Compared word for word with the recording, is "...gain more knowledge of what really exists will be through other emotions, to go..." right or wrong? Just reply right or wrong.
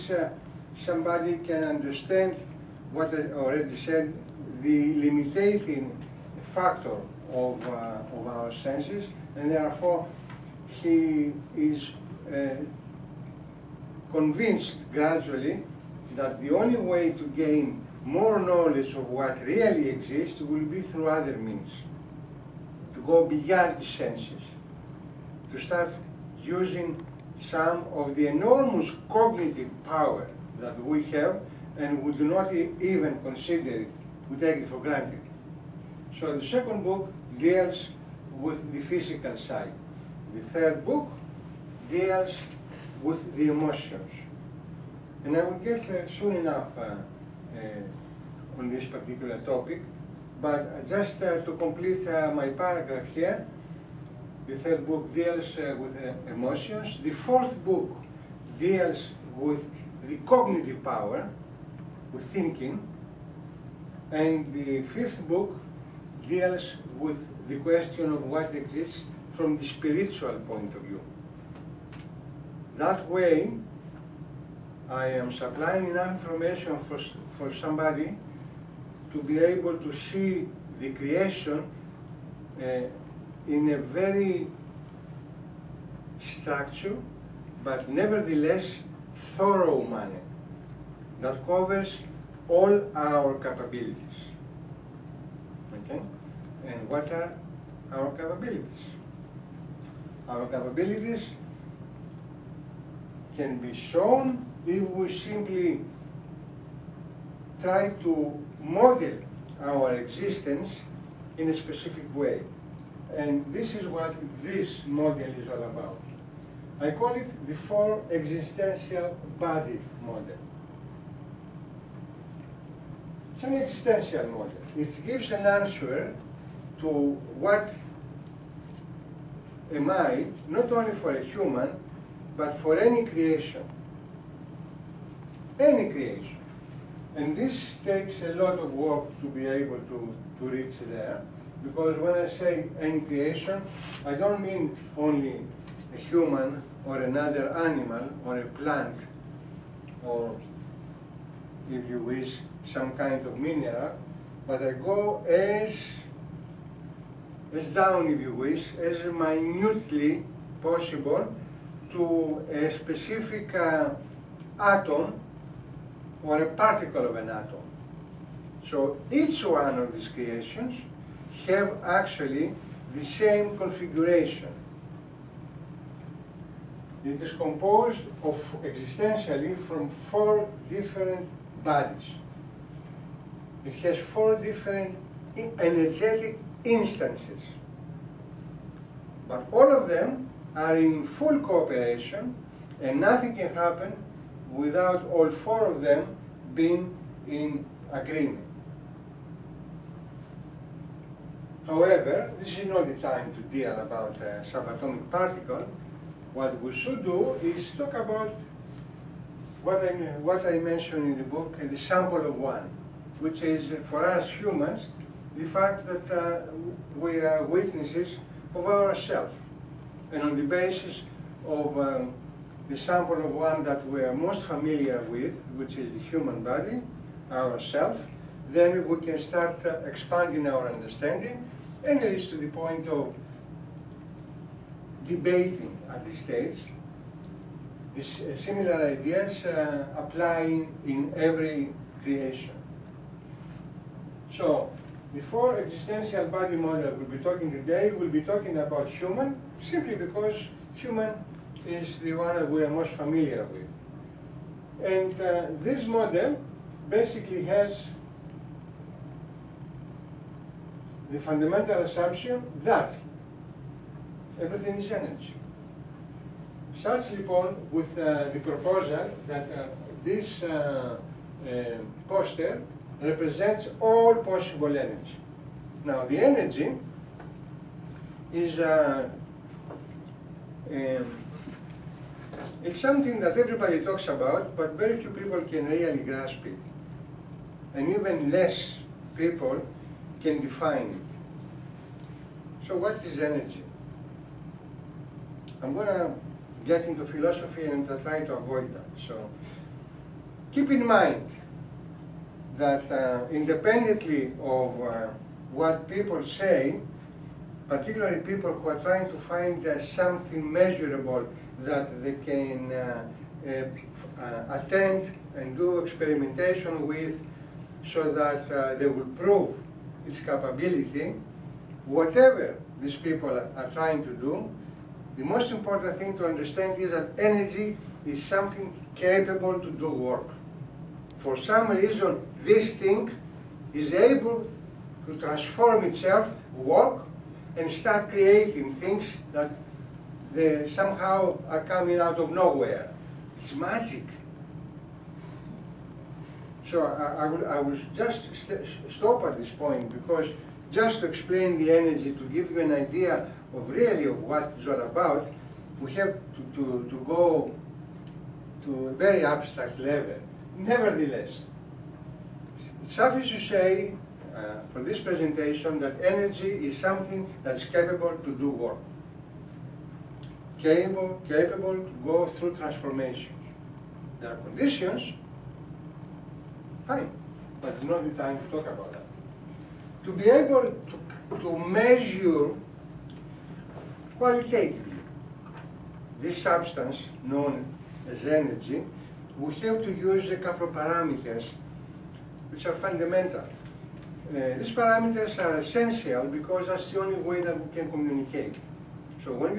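wrong.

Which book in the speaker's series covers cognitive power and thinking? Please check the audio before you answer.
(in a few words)
Fourth.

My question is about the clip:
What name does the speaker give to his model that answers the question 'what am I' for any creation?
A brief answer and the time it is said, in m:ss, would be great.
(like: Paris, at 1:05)
Four existential body model, at 1:57.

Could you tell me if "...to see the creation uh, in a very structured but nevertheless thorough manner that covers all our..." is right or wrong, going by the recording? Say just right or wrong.
right.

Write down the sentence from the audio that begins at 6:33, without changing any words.
Uh, these parameters are essential because that's the only way that we can communicate.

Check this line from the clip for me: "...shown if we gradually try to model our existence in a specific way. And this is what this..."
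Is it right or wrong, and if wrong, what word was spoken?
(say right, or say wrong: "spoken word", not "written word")
wrong: "simply", not "gradually".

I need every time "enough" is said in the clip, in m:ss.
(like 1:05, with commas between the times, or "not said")
0:46, 1:15.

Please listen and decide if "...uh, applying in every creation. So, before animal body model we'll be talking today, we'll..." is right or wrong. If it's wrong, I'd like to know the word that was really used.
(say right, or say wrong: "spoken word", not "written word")
wrong: "existential", not "animal".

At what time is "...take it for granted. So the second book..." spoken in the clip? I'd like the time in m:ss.
0:34.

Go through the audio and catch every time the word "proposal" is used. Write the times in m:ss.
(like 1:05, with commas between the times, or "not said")
4:28.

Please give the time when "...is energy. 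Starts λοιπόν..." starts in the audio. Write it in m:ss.
4:24.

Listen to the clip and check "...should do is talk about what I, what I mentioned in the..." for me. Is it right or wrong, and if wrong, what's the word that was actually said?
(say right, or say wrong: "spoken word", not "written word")
right.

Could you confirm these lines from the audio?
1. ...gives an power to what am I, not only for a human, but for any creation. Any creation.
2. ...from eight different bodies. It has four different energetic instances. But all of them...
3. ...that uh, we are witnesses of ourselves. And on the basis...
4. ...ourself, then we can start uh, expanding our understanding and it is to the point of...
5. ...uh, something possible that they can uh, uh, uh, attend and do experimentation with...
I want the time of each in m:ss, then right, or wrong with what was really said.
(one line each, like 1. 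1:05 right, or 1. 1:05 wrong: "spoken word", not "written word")
1. 2:05 wrong: "answer", not "power"
2. 2:59 wrong: "four", not "eight"
3. 3:35 right
4. 3:47 right
5. 5:09 wrong: "measurable", not "possible".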